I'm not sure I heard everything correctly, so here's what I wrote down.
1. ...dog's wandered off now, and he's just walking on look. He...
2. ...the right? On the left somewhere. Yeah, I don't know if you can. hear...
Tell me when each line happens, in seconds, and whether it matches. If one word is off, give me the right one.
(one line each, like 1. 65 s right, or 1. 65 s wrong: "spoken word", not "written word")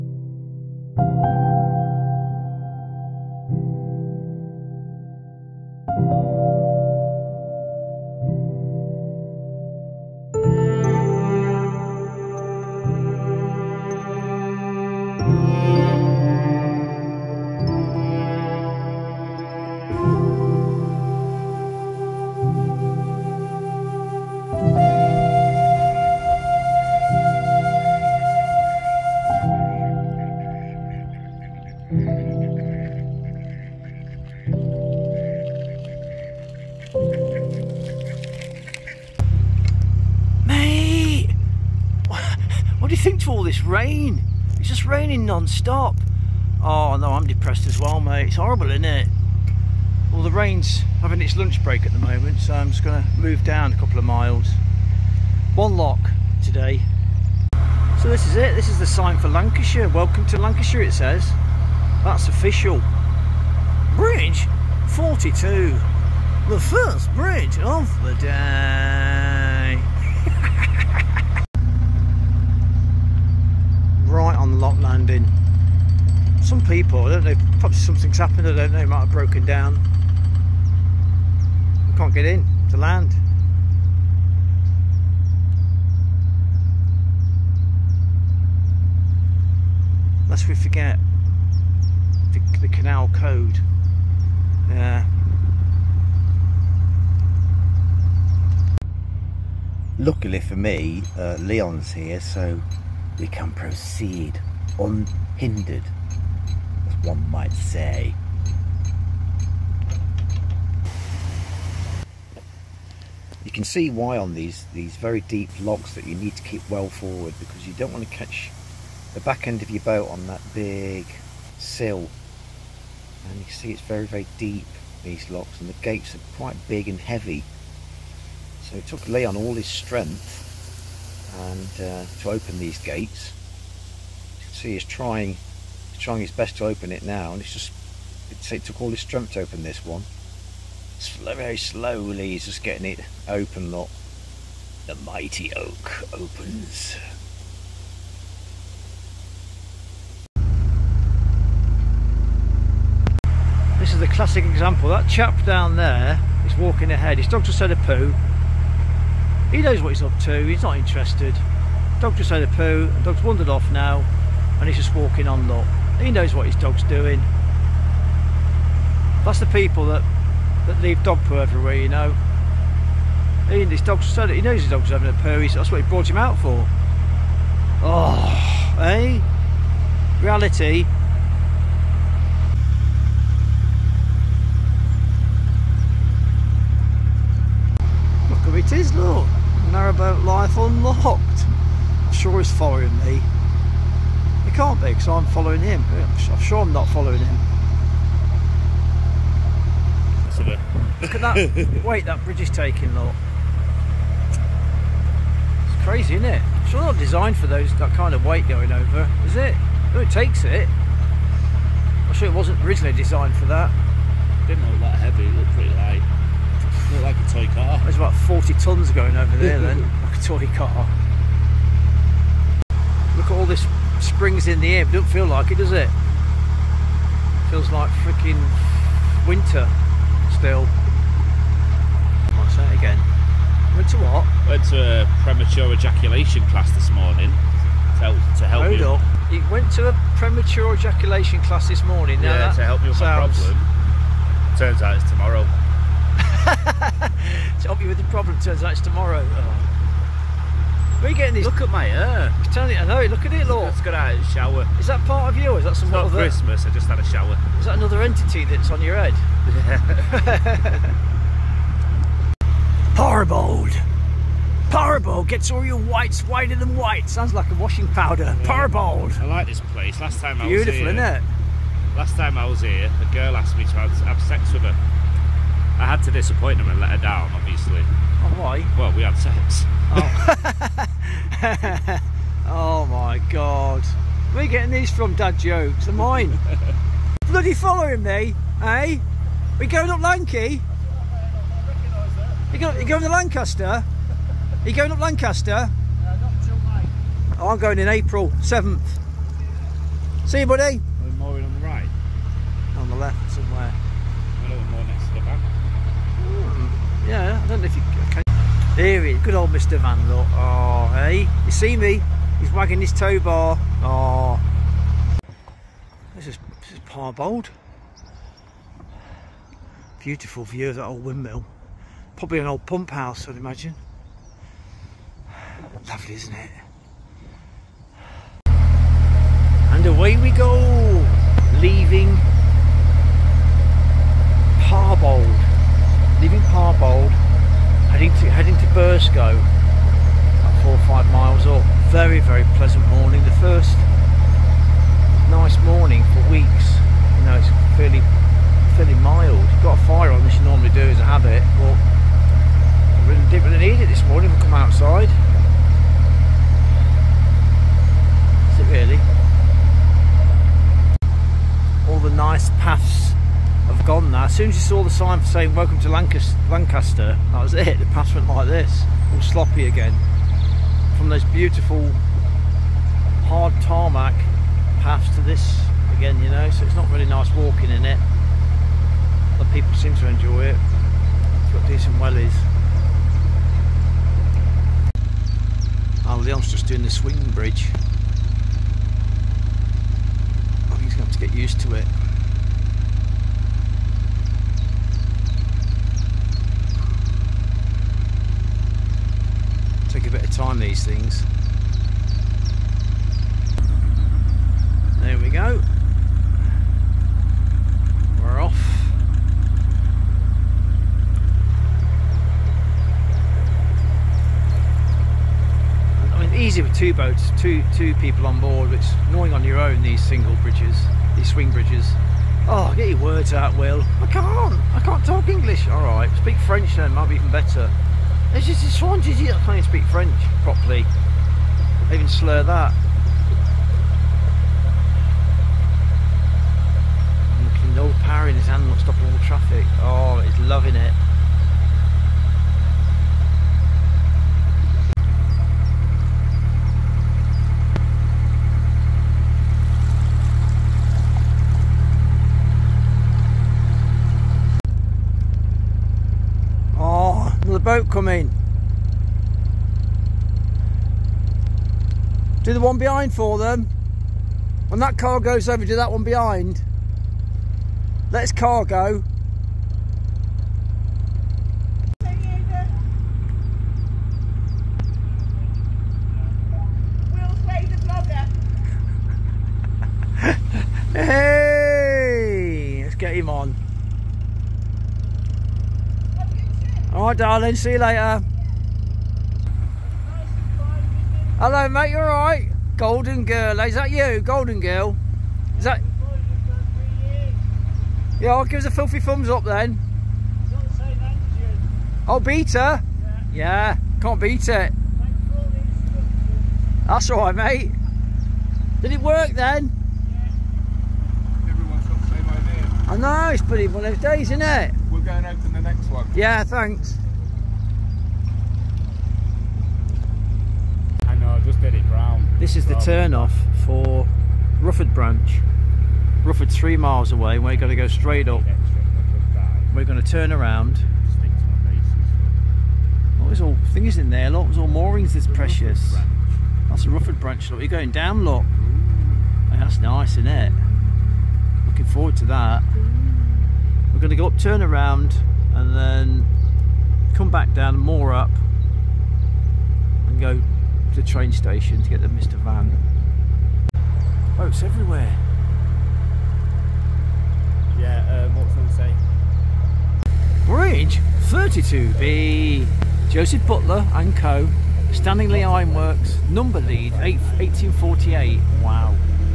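1. 163 s right
2. 301 s right.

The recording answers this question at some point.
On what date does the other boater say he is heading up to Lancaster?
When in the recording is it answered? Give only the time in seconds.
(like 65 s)
297 s.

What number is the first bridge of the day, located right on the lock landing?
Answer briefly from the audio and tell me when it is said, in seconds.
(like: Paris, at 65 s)
42, at 63 s.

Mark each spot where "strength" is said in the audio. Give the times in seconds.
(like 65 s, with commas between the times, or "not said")
129 s, 138 s.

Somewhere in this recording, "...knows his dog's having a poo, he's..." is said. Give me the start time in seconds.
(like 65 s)
174 s.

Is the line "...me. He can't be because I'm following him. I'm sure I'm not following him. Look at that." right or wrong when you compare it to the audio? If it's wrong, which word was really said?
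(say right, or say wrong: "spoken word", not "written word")
right.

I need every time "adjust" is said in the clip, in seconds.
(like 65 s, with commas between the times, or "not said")
not said.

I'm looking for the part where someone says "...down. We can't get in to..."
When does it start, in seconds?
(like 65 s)
79 s.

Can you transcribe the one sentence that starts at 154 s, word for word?
That chap down there is walking ahead.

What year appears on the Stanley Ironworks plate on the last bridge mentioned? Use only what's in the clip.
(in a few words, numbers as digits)
1848.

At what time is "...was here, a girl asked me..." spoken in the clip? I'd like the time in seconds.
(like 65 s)
272 s.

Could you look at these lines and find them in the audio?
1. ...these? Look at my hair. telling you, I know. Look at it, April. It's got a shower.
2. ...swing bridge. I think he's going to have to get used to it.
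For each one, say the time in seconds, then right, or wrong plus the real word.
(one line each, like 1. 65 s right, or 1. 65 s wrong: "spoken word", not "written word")
1. 251 s wrong: "Lord", not "April"
2. 386 s right.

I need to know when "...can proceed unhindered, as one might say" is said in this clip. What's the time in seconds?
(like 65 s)
103 s.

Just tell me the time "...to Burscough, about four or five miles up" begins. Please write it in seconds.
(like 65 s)
338 s.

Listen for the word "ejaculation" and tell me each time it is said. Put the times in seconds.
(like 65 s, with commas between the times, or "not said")
235 s, 240 s.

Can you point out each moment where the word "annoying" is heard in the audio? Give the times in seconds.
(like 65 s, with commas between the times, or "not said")
419 s.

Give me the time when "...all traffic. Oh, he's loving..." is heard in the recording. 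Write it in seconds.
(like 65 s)
439 s.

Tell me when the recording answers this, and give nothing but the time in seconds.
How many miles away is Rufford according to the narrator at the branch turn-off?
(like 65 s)
526 s.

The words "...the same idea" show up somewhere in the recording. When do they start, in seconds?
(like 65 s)
512 s.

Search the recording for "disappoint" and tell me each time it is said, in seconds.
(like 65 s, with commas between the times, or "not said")
276 s.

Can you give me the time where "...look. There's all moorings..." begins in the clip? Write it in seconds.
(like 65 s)
534 s.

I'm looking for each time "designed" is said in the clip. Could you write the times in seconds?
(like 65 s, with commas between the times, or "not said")
206 s, 212 s.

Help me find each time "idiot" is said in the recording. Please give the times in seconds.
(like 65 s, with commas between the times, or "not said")
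428 s.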